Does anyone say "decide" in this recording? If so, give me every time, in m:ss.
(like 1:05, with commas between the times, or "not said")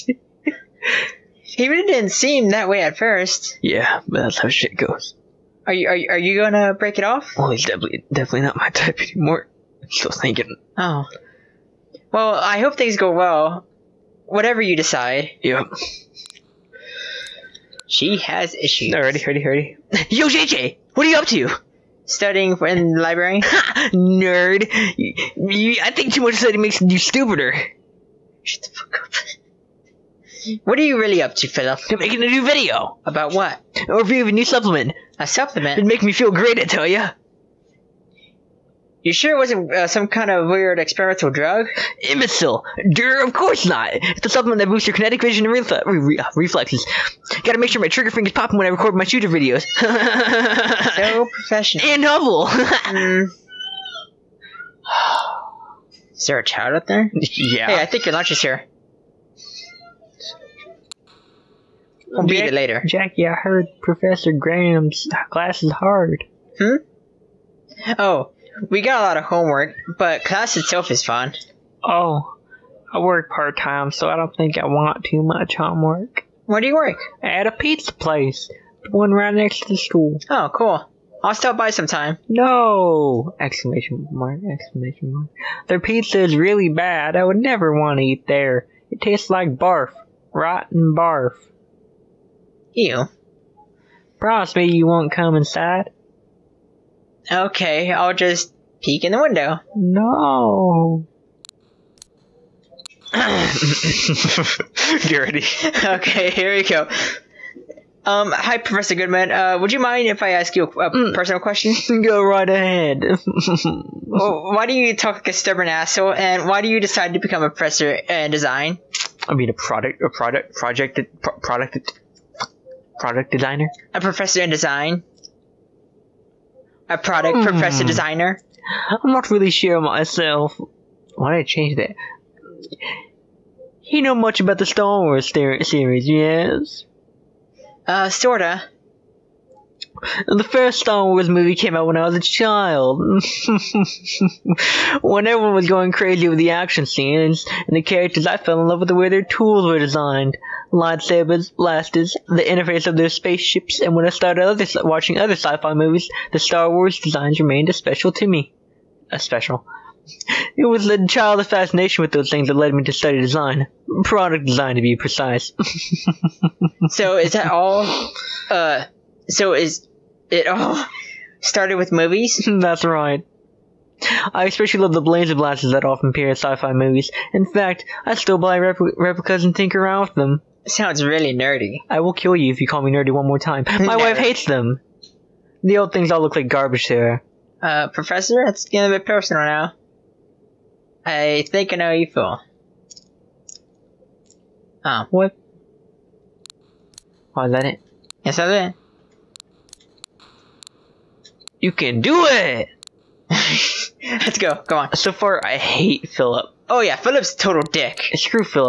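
0:14, 1:56.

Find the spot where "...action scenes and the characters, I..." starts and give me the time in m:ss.
2:26.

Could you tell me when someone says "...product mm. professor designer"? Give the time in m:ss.
2:06.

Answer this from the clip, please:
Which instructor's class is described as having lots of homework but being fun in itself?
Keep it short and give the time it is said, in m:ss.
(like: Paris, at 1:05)
Professor Graham, at 1:03.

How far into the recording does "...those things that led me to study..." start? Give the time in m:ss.
2:42.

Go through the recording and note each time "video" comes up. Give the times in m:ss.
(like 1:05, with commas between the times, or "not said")
0:32, 0:49.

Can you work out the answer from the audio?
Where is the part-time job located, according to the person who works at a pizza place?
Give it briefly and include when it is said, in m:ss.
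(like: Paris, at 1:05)
right next to the school, at 1:19.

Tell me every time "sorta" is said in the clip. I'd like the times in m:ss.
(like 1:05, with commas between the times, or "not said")
2:18.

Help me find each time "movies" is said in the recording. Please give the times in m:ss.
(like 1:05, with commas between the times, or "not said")
2:21, 2:35, 2:51, 2:56.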